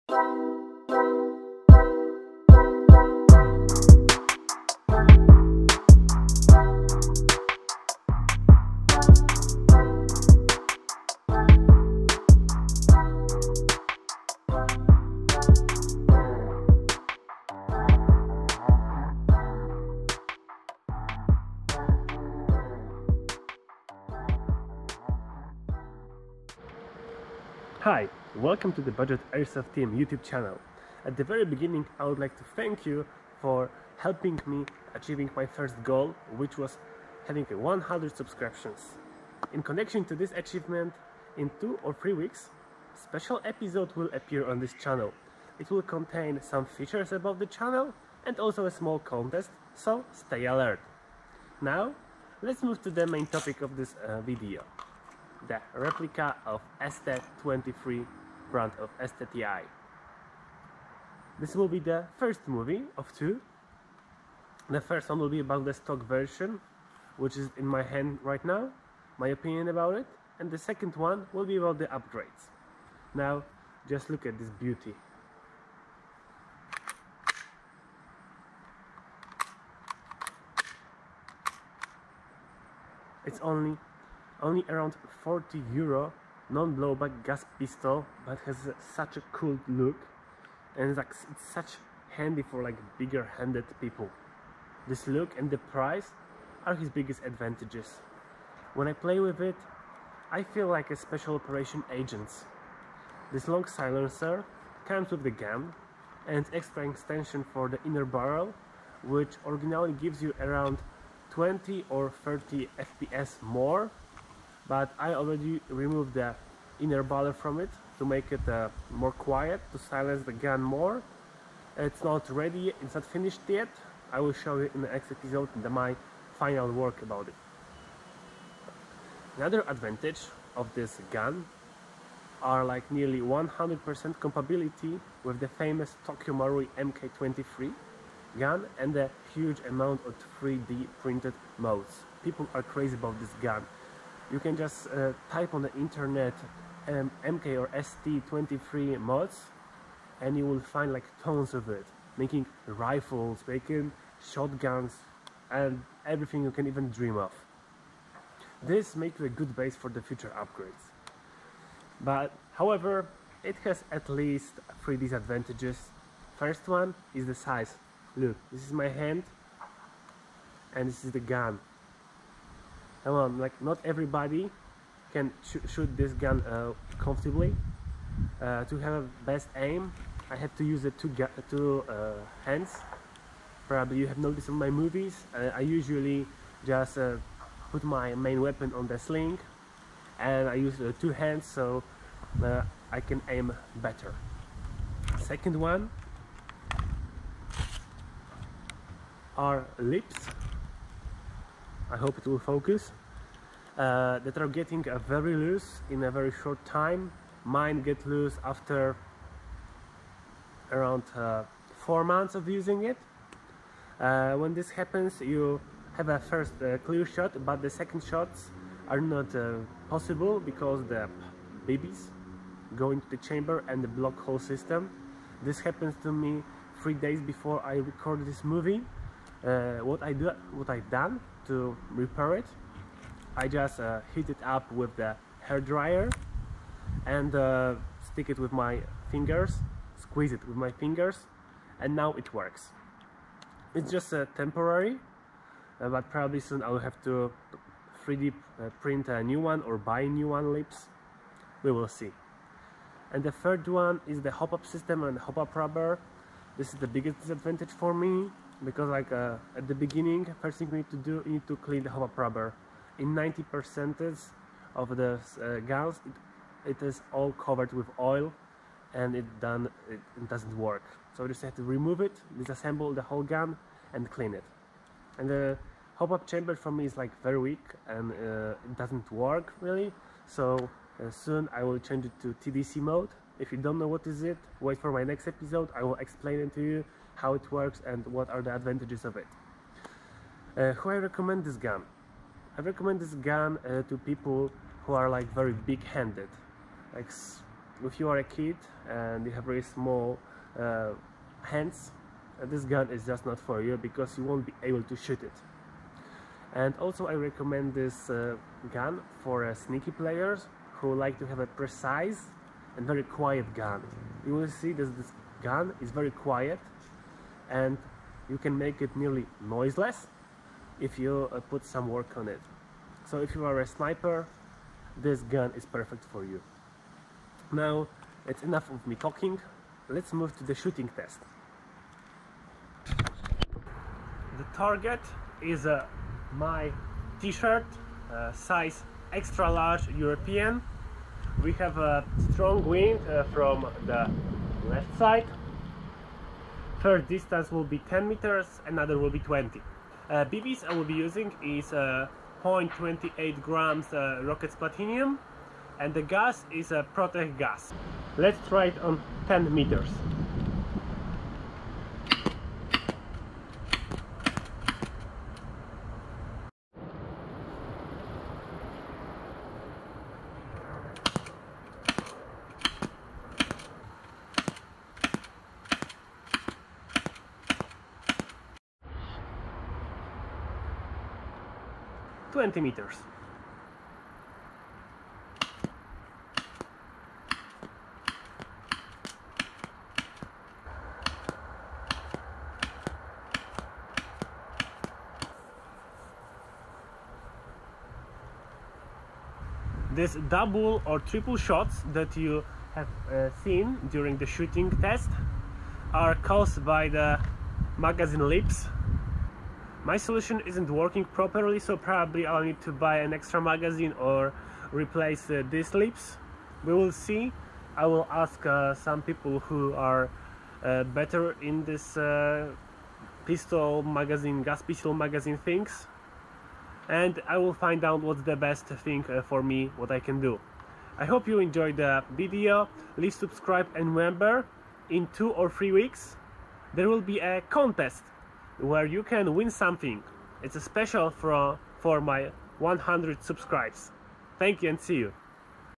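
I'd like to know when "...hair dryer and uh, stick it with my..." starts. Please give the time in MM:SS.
03:55.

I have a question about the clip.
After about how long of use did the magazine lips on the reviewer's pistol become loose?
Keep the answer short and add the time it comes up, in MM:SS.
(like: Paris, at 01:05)
4 months, at 03:31.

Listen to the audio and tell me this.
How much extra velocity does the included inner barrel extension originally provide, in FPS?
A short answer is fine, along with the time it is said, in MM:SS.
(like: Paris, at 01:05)
20 or 30, at 01:51.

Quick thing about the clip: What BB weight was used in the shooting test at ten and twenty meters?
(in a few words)
0.28 grams.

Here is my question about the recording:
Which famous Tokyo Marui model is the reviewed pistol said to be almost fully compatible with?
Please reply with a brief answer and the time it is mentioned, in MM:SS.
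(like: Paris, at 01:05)
MK23, at 02:16.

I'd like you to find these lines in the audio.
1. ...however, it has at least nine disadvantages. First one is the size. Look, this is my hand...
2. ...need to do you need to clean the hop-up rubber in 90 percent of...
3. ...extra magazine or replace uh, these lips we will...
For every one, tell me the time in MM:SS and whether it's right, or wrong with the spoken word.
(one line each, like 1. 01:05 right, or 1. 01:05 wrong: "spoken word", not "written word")
1. 02:42 wrong: "three", not "nine"
2. 04:20 right
3. 06:53 right.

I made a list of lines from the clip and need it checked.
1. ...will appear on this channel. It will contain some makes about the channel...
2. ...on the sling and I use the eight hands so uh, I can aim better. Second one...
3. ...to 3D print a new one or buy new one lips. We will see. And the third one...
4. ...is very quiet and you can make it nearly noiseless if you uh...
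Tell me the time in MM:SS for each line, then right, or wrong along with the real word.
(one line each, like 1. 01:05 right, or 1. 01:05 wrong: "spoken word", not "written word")
1. 00:43 wrong: "features", not "makes"
2. 03:08 wrong: "two", not "eight"
3. 04:07 right
4. 05:15 right.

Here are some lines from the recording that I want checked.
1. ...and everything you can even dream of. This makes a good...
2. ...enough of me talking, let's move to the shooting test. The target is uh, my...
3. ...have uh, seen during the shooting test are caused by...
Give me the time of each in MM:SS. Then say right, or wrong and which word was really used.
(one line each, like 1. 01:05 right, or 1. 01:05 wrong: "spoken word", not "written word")
1. 02:35 right
2. 05:28 right
3. 06:42 right.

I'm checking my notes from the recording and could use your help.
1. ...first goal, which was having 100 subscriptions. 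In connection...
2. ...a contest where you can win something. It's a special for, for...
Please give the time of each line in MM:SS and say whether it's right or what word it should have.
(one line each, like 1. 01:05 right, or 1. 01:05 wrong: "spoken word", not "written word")
1. 00:35 right
2. 07:17 right.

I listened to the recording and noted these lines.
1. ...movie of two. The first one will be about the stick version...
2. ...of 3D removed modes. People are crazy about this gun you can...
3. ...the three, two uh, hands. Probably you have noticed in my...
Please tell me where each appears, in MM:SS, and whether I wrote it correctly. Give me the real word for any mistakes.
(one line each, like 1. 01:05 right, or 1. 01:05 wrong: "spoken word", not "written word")
1. 01:02 wrong: "stock", not "stick"
2. 02:20 wrong: "printed", not "removed"
3. 03:00 wrong: "two", not "three".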